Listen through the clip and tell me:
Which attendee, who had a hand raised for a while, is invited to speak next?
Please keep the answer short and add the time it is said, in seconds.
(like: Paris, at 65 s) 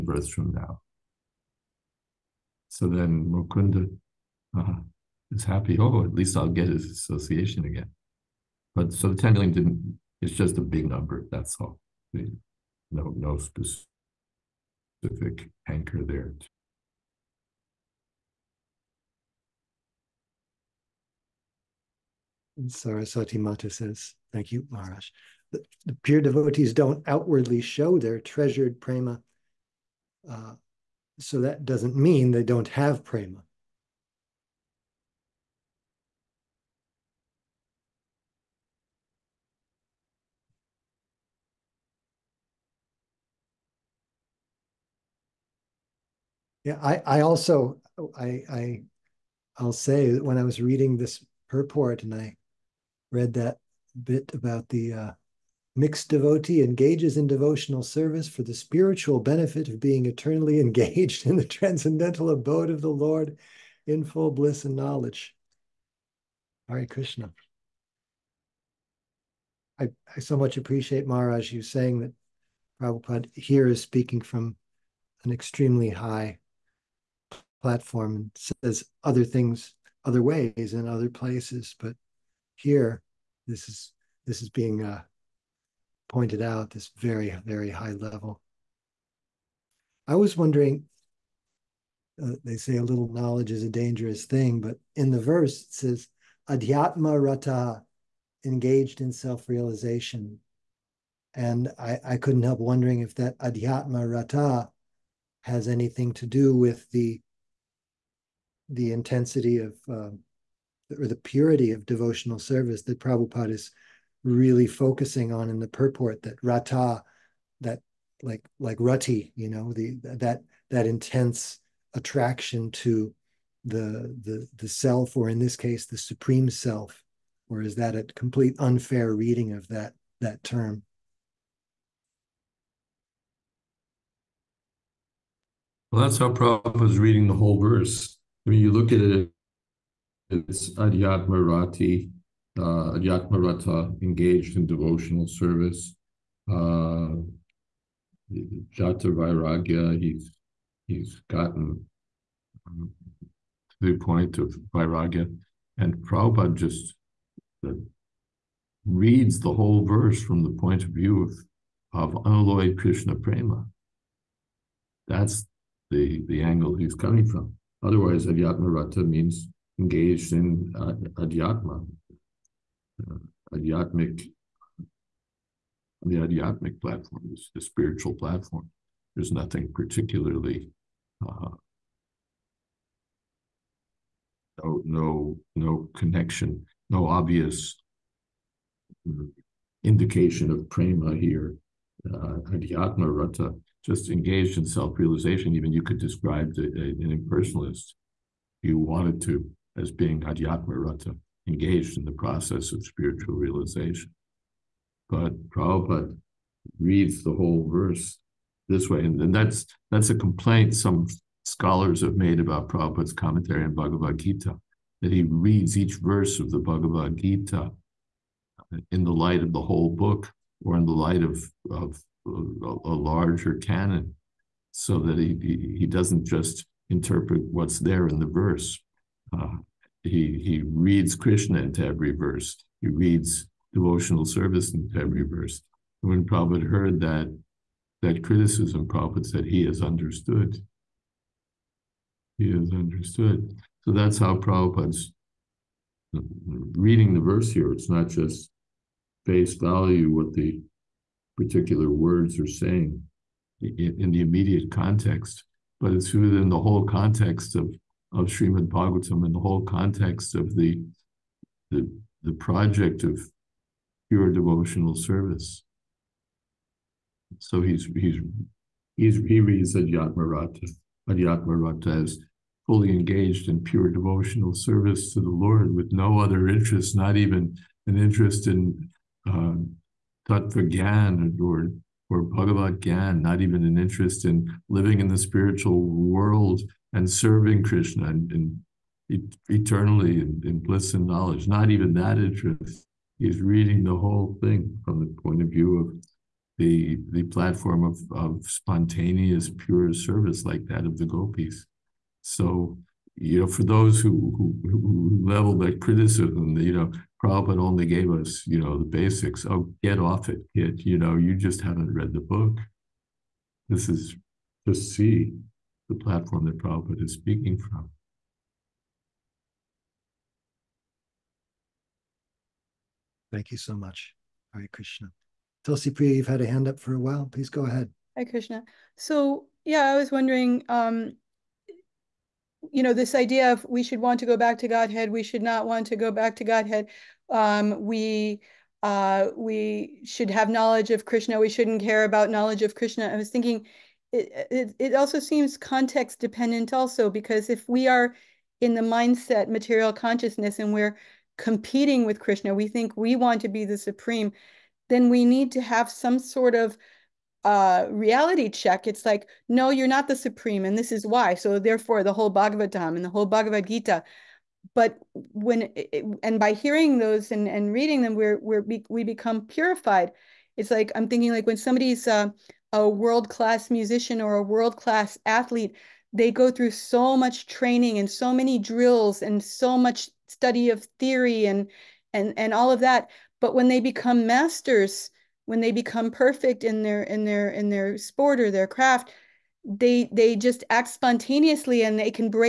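Tulsi Priya, at 325 s.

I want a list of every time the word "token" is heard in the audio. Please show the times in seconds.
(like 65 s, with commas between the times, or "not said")
not said.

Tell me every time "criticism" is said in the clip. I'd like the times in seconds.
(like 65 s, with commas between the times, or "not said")
238 s, 305 s.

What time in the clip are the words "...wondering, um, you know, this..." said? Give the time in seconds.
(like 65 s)
330 s.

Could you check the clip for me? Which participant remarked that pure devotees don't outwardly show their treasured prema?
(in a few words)
Saraswati Mata.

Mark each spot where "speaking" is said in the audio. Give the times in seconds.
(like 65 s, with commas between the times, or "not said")
73 s, 317 s.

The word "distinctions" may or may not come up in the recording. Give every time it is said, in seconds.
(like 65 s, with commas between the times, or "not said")
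not said.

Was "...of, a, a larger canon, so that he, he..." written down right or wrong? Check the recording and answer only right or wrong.
right.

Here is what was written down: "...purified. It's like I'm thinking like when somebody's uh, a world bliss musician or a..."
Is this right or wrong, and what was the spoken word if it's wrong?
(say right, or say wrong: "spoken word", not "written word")
wrong: "class", not "bliss".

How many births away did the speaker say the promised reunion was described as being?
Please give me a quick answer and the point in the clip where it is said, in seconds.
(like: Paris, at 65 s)
10 million, at 9 s.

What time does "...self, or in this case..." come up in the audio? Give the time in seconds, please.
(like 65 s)
124 s.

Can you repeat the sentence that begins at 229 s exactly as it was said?
Uh, he he reads Krishna into every verse.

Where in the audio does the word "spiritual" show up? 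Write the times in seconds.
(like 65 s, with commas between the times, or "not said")
58 s, 177 s, 202 s, 285 s.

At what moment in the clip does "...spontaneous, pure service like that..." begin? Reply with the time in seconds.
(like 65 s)
298 s.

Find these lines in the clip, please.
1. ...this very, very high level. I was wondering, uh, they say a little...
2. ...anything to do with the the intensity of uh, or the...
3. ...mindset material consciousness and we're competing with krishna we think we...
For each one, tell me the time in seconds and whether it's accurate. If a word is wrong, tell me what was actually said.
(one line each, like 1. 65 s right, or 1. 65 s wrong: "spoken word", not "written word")
1. 86 s right
2. 105 s right
3. 348 s right.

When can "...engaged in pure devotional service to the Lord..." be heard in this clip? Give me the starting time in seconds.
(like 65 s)
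272 s.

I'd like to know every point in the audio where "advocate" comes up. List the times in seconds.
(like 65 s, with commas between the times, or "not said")
not said.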